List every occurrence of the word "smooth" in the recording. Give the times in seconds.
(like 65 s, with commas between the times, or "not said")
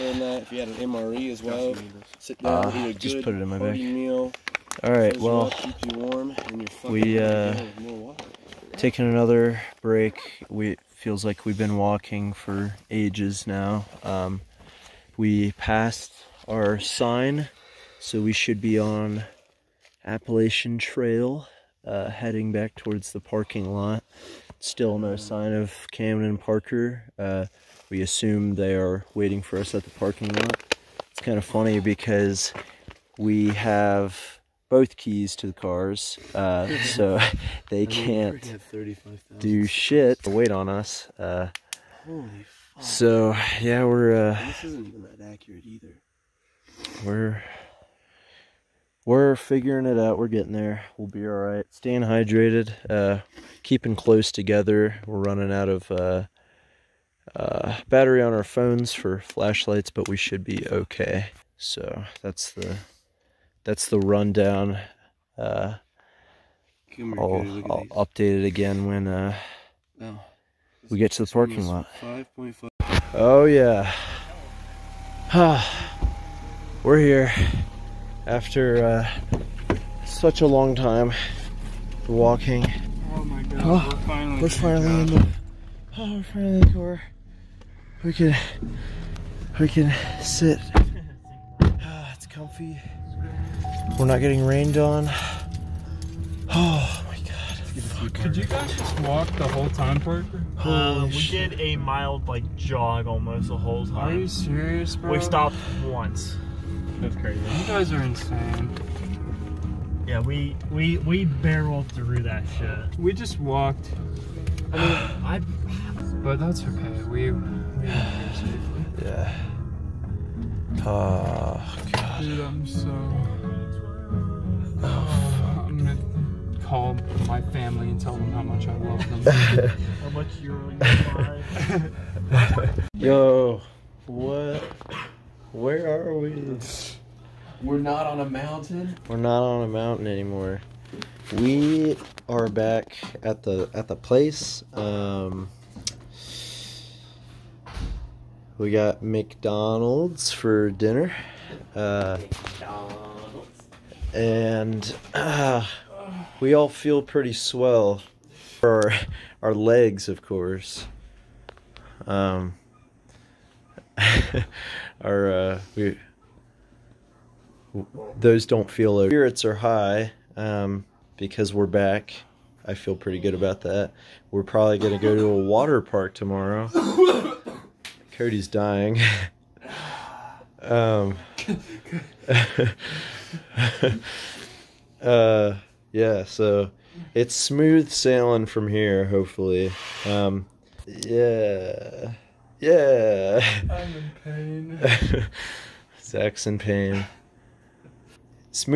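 187 s.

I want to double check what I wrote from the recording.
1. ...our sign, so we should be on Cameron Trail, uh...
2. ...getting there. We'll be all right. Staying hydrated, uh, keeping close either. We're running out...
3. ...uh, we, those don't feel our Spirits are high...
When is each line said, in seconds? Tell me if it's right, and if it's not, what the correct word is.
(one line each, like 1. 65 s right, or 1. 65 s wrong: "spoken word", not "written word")
1. 16 s wrong: "Appalachian", not "Cameron"
2. 50 s wrong: "together", not "either"
3. 165 s right.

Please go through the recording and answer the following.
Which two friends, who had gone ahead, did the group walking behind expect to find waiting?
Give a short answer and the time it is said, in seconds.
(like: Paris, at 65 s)
Cameron and Parker, at 25 s.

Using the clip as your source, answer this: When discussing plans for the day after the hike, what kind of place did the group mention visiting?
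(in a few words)
water park.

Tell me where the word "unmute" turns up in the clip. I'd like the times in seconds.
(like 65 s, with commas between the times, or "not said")
not said.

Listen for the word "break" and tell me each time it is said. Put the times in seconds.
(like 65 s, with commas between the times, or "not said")
9 s.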